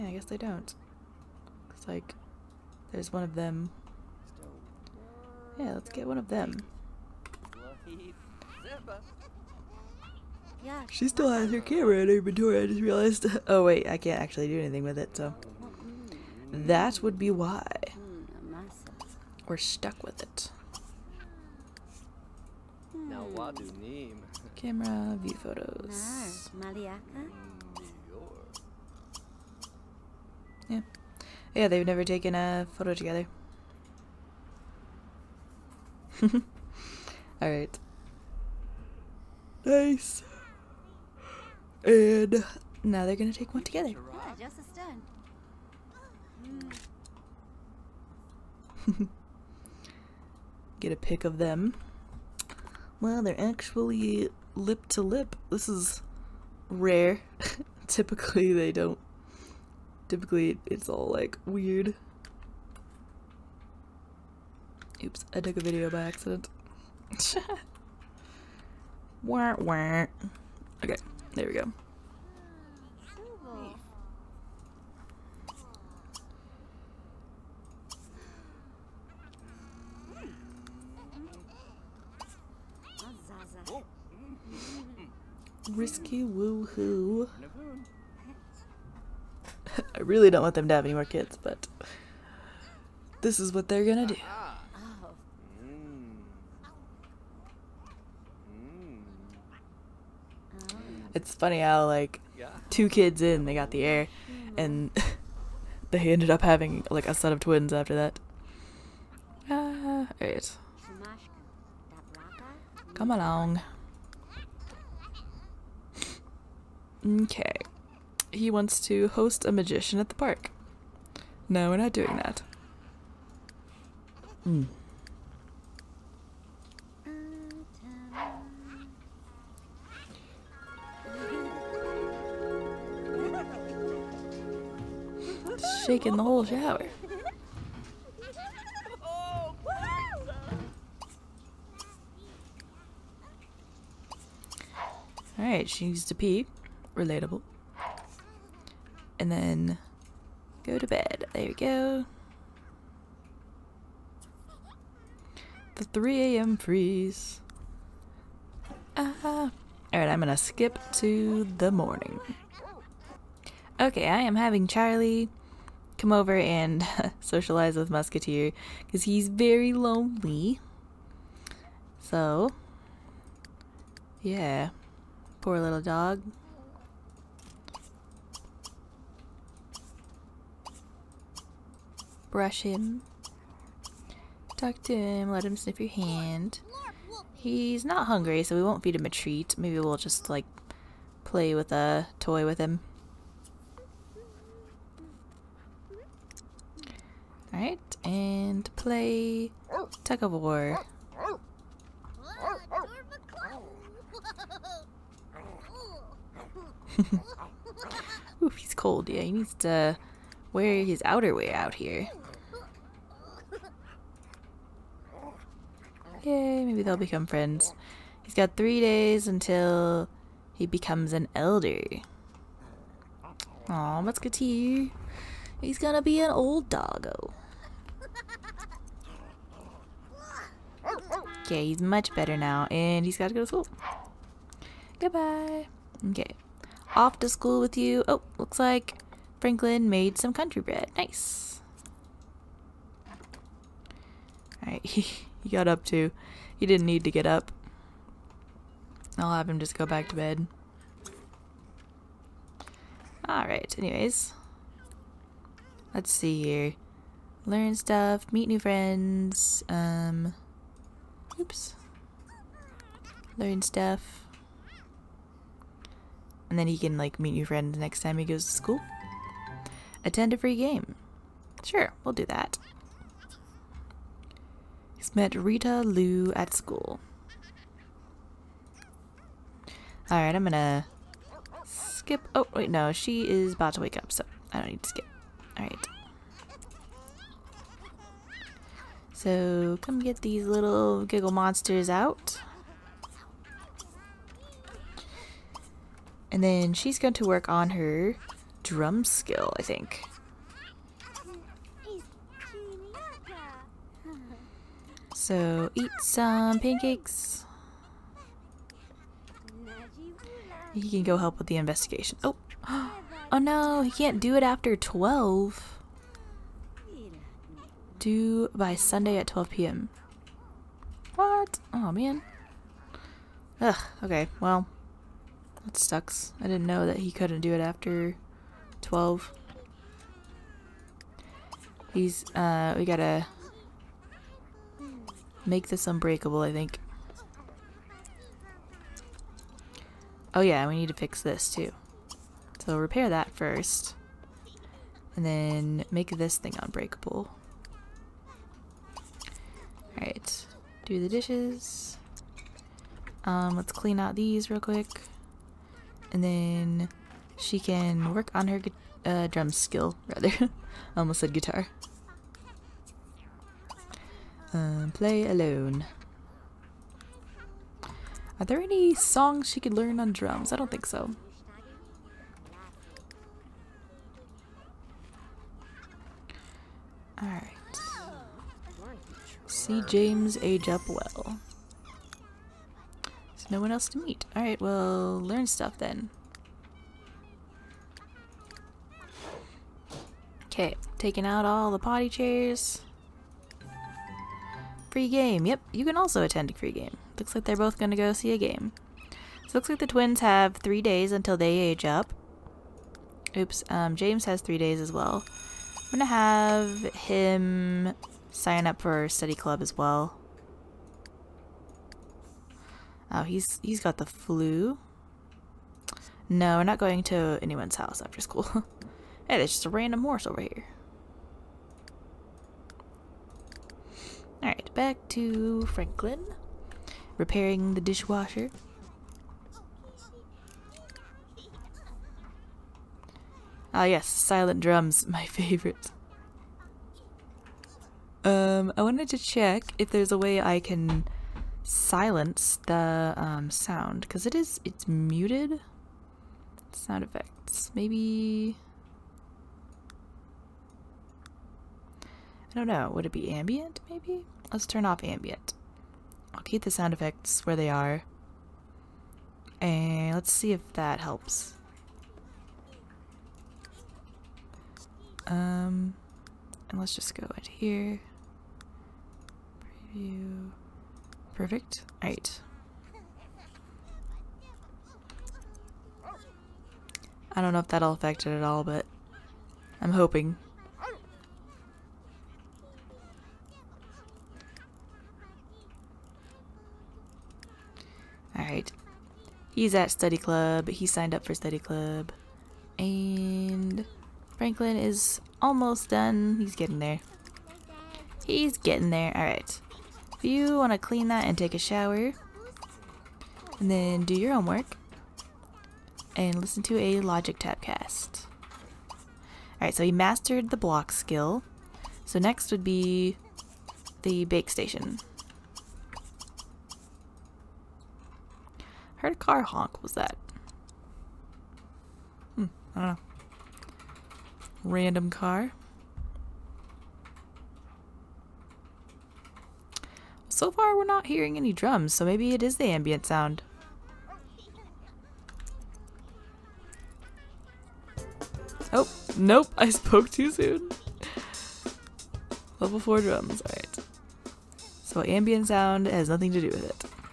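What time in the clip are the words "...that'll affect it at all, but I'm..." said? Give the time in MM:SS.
07:57.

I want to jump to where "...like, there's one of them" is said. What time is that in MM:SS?
00:01.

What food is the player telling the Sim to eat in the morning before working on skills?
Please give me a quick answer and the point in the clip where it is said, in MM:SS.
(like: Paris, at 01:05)
Pancakes, at 05:06.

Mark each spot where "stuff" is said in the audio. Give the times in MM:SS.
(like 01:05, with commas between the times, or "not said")
04:17, 04:23, 06:25.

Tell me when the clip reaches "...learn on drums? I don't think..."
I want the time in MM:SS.
06:09.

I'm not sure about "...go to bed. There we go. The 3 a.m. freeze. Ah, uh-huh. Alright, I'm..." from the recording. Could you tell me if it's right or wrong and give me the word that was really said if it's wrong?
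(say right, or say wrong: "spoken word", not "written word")
right.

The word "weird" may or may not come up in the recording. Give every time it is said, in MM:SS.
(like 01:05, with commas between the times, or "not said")
01:01.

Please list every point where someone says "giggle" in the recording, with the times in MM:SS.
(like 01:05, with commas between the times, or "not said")
04:51.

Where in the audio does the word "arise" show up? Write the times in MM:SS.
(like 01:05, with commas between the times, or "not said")
not said.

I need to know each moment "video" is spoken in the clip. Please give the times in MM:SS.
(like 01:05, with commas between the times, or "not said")
01:05.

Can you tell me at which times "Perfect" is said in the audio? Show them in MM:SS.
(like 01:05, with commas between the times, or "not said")
07:51.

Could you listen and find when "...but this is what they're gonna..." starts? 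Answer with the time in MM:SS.
01:31.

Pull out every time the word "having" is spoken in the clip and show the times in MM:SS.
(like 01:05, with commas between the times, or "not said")
01:46, 02:44.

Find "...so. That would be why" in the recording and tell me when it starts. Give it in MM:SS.
00:15.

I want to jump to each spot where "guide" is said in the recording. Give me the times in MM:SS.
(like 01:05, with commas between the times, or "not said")
not said.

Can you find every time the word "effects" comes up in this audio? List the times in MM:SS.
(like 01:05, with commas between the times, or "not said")
07:27, 07:36.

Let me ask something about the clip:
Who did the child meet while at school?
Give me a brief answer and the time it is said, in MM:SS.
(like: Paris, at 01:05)
Rita Lou, at 04:35.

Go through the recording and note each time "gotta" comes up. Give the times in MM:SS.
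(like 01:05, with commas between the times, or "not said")
03:53, 05:32.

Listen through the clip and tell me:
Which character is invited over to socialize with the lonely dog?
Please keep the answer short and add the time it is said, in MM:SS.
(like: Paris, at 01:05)
Charlie, at 02:44.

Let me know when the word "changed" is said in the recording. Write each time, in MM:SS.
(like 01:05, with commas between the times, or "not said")
not said.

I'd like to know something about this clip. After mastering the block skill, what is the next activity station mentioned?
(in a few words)
Bake station.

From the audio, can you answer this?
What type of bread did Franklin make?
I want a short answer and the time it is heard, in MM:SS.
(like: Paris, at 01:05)
Country bread, at 04:00.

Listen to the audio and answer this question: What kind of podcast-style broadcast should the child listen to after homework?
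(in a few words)
Logic Tabcast.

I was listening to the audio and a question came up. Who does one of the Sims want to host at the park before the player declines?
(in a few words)
A magician.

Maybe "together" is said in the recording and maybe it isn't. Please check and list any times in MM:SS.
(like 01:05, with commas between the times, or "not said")
00:32, 00:43.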